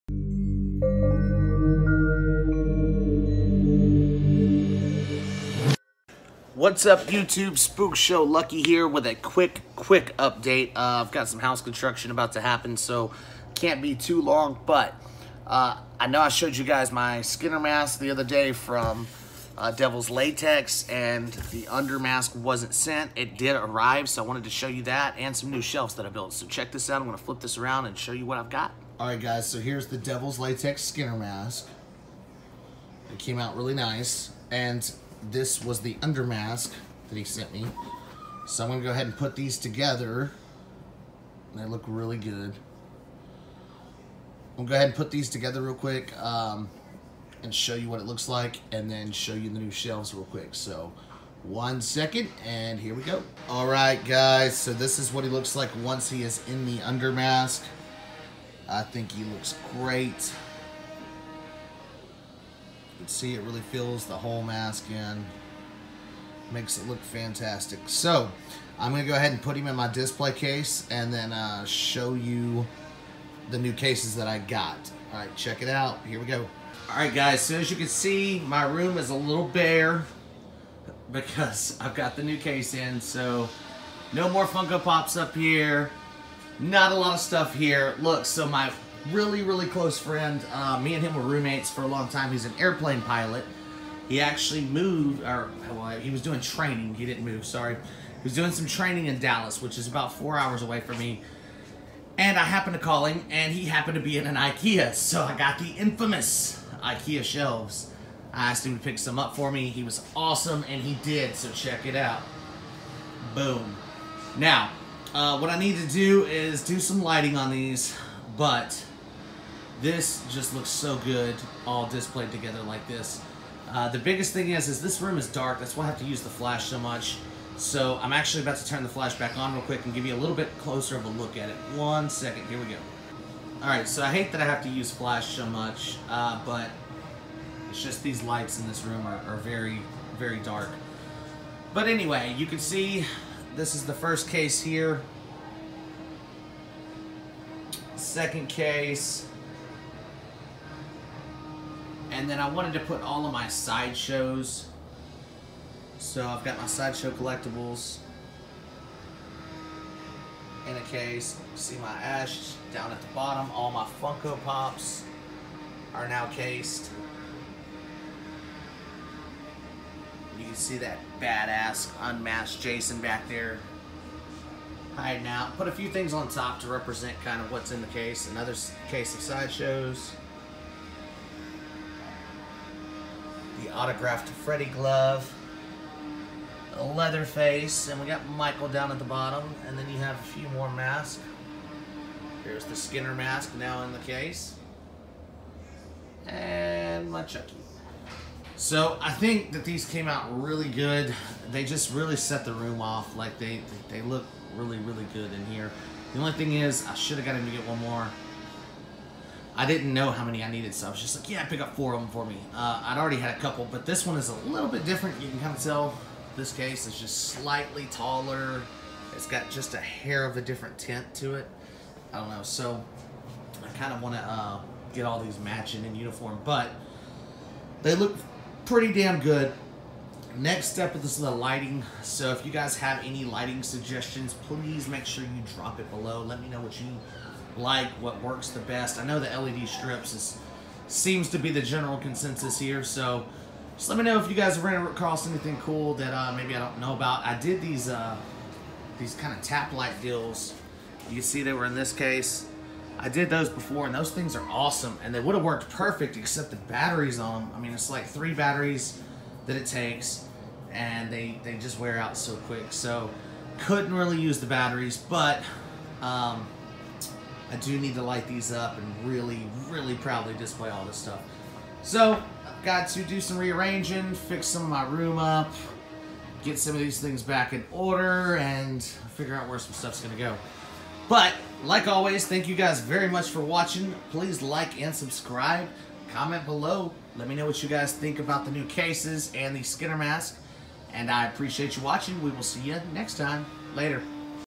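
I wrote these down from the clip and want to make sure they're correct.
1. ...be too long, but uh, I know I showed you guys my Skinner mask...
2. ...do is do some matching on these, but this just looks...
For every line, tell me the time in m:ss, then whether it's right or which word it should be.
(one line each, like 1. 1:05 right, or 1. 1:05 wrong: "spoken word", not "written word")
1. 0:13 right
2. 1:55 wrong: "lighting", not "matching".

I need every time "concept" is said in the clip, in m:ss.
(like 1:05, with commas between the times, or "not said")
not said.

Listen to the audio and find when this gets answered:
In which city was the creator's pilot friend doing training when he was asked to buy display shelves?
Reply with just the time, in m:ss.
1:39.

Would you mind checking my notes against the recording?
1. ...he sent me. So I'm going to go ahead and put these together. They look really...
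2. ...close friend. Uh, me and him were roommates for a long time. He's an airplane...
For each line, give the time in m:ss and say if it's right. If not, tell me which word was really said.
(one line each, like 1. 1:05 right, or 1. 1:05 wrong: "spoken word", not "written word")
1. 0:37 right
2. 1:29 right.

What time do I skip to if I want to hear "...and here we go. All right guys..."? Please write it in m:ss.
0:52.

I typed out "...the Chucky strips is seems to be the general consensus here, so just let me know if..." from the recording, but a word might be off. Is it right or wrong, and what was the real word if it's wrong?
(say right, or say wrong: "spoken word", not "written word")
wrong: "LED", not "Chucky".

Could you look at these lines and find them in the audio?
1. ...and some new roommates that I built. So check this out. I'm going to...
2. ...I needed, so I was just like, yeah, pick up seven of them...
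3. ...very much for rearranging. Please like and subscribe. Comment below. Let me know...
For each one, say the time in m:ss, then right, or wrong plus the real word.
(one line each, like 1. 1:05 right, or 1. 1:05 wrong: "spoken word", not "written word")
1. 0:25 wrong: "shelves", not "roommates"
2. 3:30 wrong: "four", not "seven"
3. 4:42 wrong: "watching", not "rearranging".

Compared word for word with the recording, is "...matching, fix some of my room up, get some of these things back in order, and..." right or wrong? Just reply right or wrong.
wrong.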